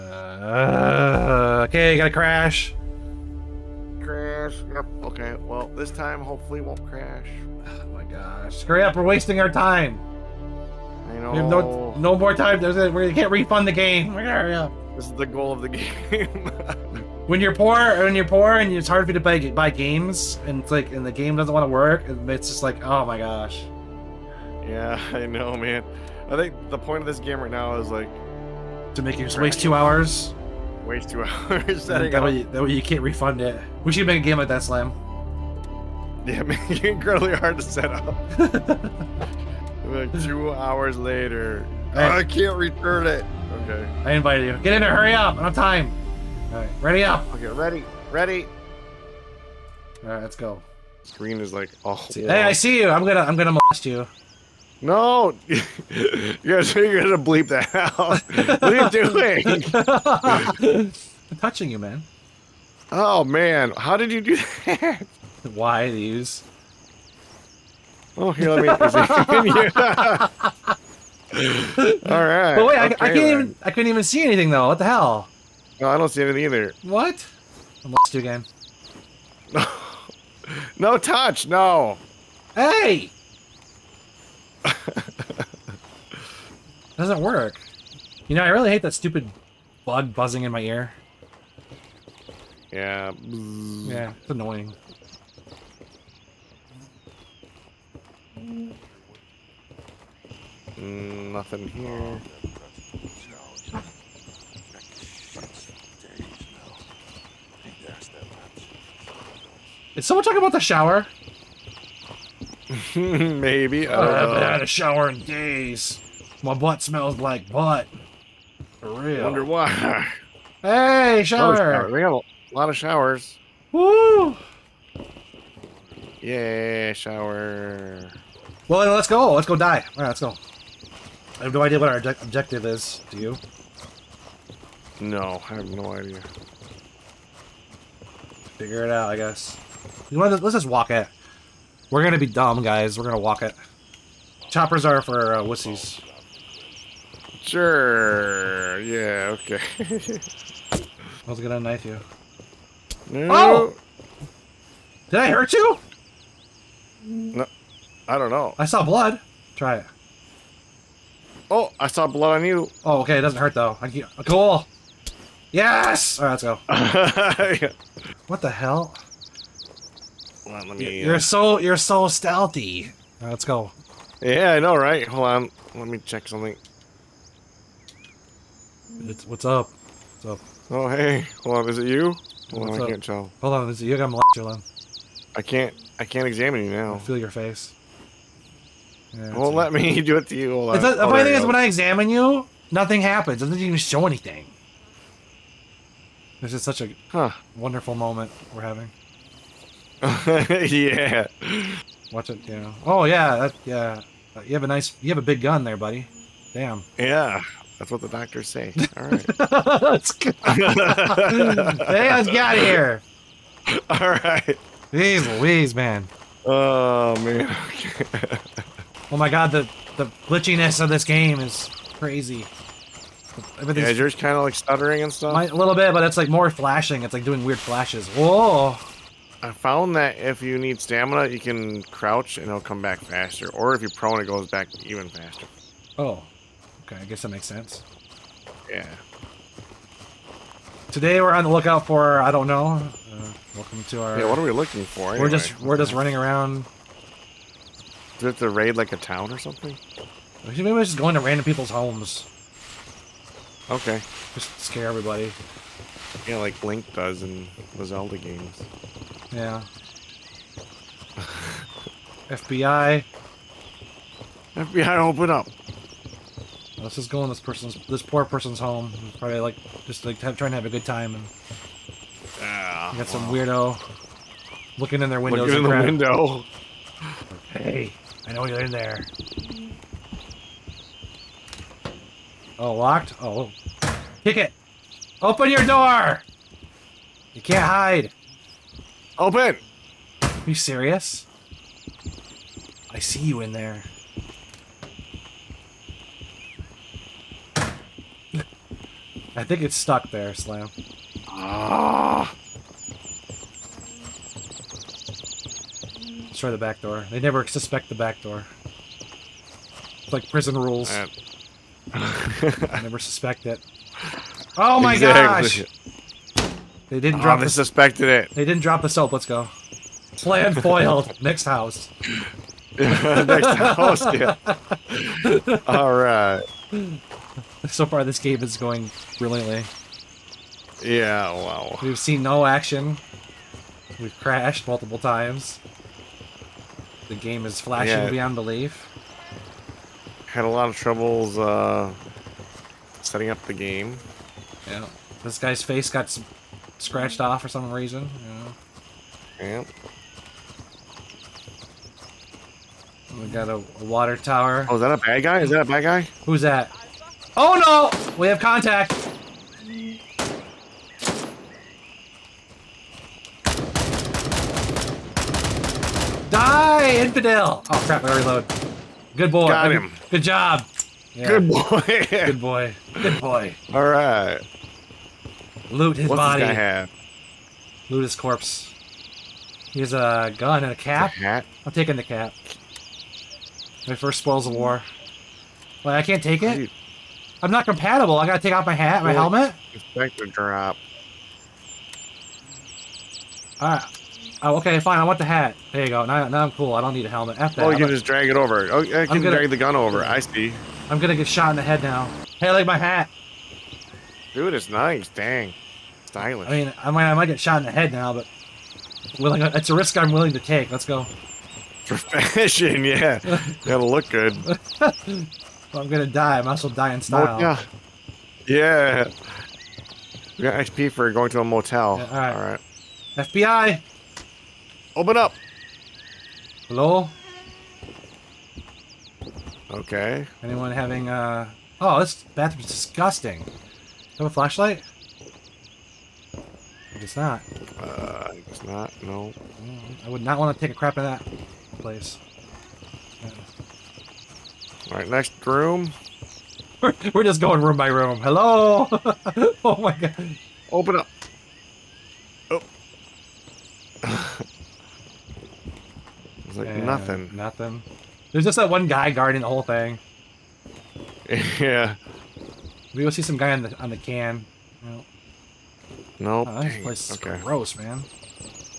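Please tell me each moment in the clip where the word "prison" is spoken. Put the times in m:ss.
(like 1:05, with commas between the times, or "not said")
5:10.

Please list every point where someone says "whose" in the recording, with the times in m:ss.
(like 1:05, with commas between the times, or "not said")
not said.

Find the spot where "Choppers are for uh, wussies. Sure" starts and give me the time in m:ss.
2:24.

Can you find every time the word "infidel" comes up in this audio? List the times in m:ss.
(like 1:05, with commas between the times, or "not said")
6:06.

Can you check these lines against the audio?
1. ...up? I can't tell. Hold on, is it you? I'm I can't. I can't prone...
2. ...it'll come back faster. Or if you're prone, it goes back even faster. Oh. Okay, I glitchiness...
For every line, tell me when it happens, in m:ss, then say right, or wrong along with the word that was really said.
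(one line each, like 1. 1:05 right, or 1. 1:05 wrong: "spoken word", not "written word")
1. 3:02 wrong: "examine", not "prone"
2. 3:52 wrong: "guess", not "glitchiness".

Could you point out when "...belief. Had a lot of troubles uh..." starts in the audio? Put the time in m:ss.
5:38.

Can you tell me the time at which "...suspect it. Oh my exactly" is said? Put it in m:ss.
5:12.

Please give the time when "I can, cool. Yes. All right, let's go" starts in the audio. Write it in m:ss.
2:43.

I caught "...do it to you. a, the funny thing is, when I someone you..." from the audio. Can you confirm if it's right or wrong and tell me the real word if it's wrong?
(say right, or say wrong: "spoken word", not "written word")
wrong: "examine", not "someone".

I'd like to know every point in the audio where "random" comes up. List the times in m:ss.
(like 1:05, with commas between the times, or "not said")
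4:11.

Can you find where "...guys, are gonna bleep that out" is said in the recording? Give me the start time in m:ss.
0:56.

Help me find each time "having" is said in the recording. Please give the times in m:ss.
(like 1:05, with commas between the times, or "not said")
3:18, 7:10.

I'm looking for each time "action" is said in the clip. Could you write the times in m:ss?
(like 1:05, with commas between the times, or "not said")
5:32.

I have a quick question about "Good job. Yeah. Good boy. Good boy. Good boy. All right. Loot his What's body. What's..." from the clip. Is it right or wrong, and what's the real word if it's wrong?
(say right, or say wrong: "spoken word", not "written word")
right.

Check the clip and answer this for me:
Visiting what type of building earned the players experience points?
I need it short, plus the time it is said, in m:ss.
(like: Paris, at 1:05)
A motel, at 7:01.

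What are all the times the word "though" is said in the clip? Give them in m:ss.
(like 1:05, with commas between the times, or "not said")
1:14, 2:43.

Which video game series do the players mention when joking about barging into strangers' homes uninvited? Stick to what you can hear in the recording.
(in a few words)
Zelda.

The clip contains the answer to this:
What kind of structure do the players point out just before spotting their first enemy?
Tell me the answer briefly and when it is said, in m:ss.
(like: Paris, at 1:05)
Water tower, at 5:53.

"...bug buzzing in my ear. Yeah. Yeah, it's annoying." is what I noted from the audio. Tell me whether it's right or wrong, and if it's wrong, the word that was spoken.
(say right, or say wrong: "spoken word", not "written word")
right.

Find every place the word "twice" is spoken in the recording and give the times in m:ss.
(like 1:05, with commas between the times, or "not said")
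not said.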